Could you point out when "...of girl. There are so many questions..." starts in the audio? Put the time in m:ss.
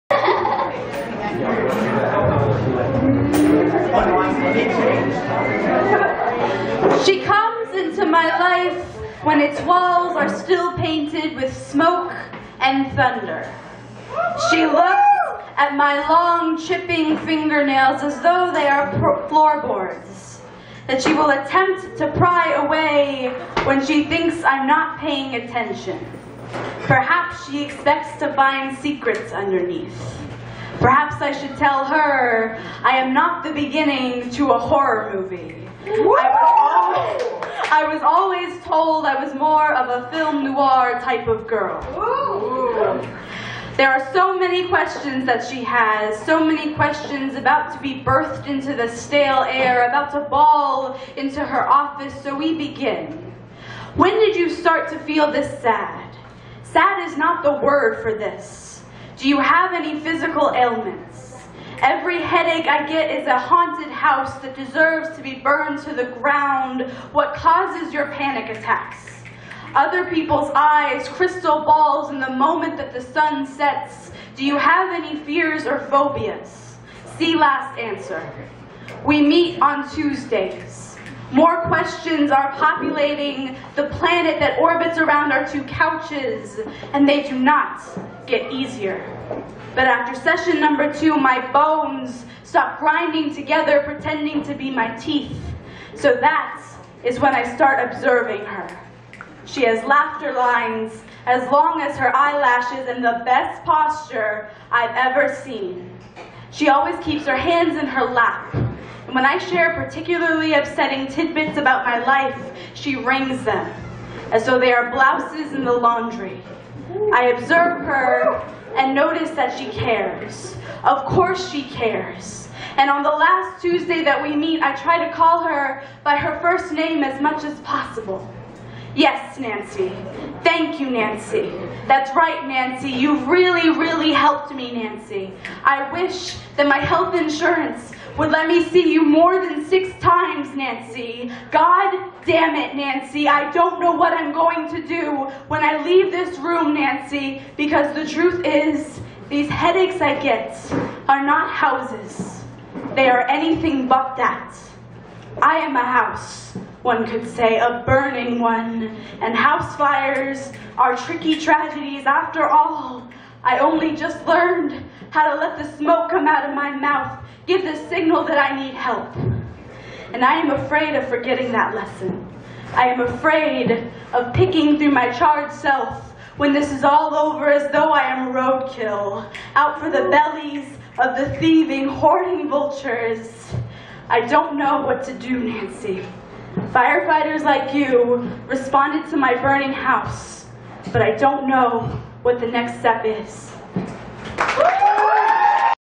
0:41.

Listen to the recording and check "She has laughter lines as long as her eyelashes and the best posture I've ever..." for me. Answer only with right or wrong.
right.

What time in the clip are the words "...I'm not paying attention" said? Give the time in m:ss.
0:24.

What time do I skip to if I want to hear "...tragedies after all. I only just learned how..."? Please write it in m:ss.
2:41.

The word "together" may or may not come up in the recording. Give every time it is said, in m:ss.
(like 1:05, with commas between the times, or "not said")
1:33.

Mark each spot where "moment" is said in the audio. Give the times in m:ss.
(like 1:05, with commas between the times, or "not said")
1:12.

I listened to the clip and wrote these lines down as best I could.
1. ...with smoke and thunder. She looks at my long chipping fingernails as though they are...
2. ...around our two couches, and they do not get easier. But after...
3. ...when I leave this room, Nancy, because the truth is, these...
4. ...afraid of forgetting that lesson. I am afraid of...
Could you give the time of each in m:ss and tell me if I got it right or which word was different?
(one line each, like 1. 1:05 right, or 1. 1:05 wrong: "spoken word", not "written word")
1. 0:11 right
2. 1:24 right
3. 2:25 right
4. 2:50 right.